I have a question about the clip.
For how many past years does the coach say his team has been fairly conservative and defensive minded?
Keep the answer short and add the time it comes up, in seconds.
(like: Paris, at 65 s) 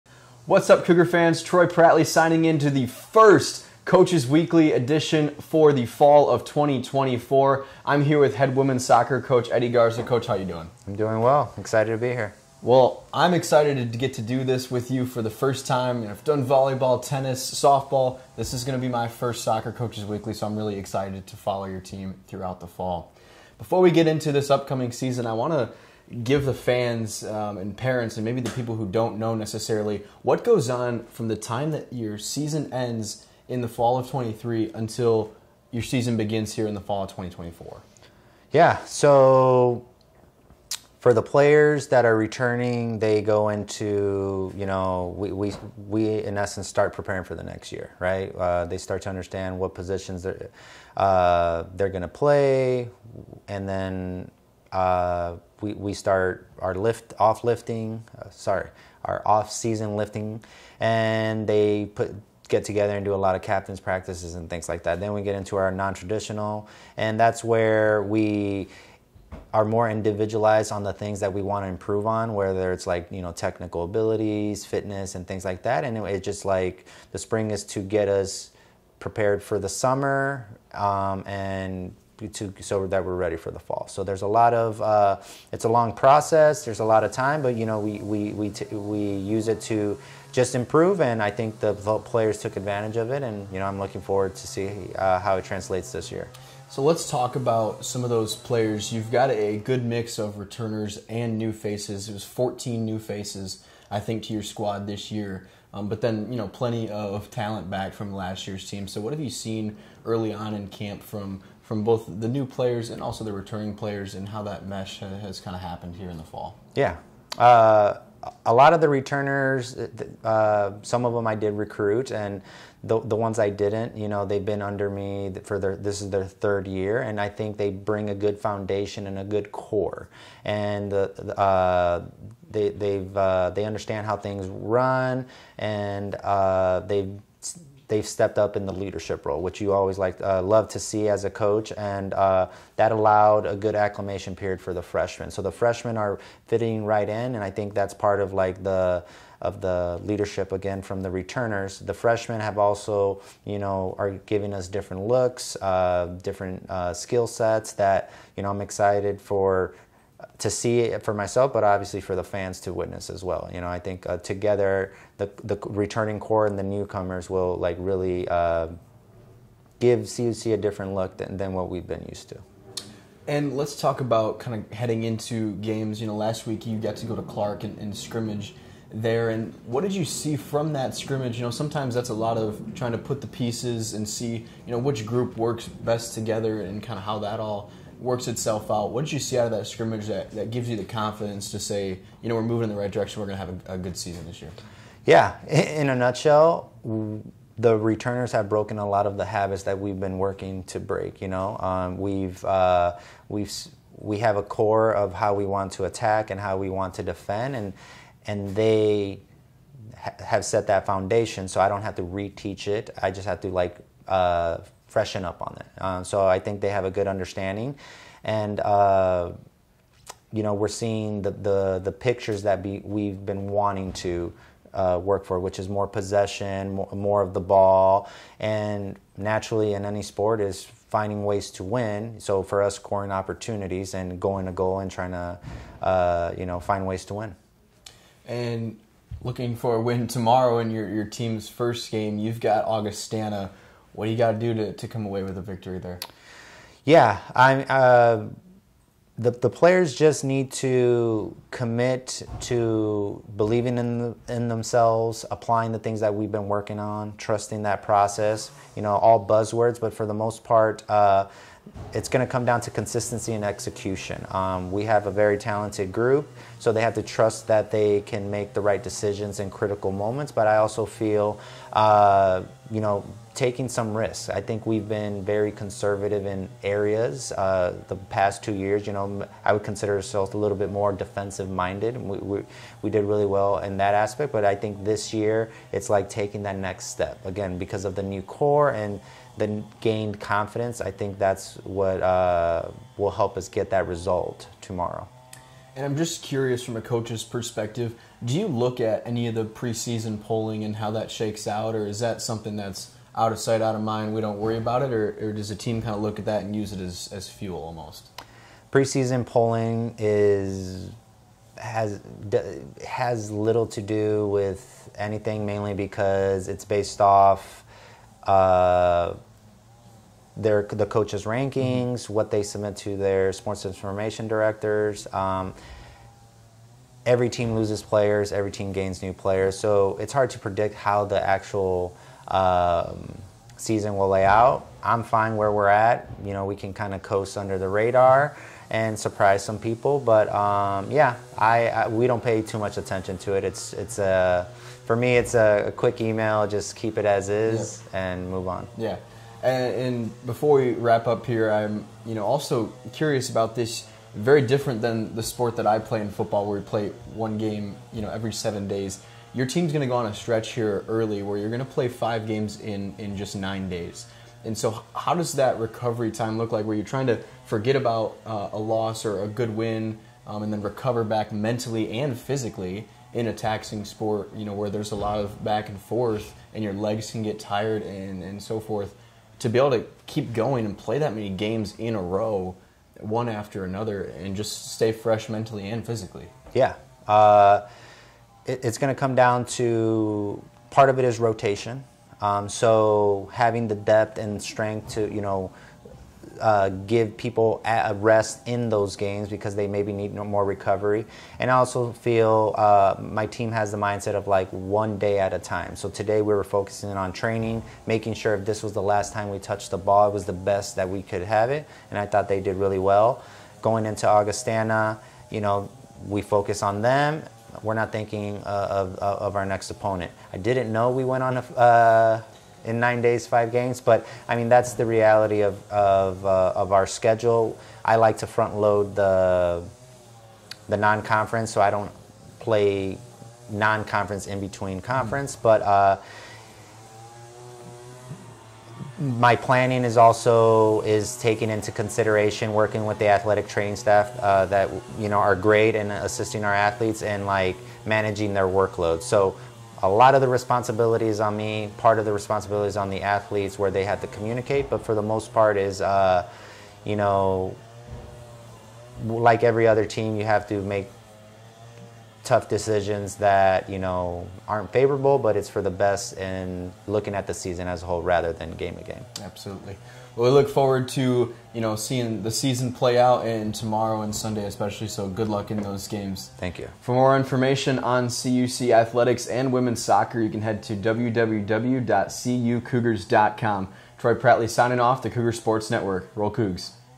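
2, at 278 s.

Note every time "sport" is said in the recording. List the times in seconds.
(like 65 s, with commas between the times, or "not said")
230 s, 323 s, 355 s, 373 s, 485 s.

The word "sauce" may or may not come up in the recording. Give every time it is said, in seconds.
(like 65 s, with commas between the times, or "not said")
not said.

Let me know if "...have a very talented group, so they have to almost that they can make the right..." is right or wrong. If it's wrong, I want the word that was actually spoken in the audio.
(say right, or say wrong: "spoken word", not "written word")
wrong: "trust", not "almost".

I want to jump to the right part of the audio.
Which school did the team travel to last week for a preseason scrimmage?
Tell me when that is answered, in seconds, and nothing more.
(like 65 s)
177 s.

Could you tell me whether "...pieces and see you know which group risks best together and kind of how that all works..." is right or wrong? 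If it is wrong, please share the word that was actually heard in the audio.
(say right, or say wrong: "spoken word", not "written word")
wrong: "works", not "risks".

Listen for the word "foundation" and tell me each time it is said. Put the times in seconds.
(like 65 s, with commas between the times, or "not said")
128 s, 210 s.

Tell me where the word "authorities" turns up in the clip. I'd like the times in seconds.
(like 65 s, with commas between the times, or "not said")
not said.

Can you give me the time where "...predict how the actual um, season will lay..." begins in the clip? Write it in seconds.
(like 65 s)
330 s.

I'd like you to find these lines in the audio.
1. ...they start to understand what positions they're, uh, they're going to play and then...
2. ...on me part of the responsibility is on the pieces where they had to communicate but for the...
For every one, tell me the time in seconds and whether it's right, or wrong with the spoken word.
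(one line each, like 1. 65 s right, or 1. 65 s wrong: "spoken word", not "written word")
1. 48 s right
2. 451 s wrong: "athletes", not "pieces".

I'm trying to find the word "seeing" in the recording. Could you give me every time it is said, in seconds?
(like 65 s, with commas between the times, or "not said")
220 s, 471 s.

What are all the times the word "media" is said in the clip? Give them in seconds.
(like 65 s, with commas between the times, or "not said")
not said.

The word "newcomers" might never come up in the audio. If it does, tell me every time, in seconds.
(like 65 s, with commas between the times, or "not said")
166 s.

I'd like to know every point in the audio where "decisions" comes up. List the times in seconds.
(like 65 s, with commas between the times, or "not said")
268 s, 462 s.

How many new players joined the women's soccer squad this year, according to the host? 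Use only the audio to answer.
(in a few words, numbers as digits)
14.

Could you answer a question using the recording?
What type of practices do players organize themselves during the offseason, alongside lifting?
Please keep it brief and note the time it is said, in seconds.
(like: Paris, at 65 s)
Captains practices, at 63 s.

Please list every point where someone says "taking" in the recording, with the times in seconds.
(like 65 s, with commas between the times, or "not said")
273 s, 286 s.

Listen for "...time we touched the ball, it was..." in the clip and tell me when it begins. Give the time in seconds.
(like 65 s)
409 s.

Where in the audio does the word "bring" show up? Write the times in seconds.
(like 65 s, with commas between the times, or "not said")
127 s.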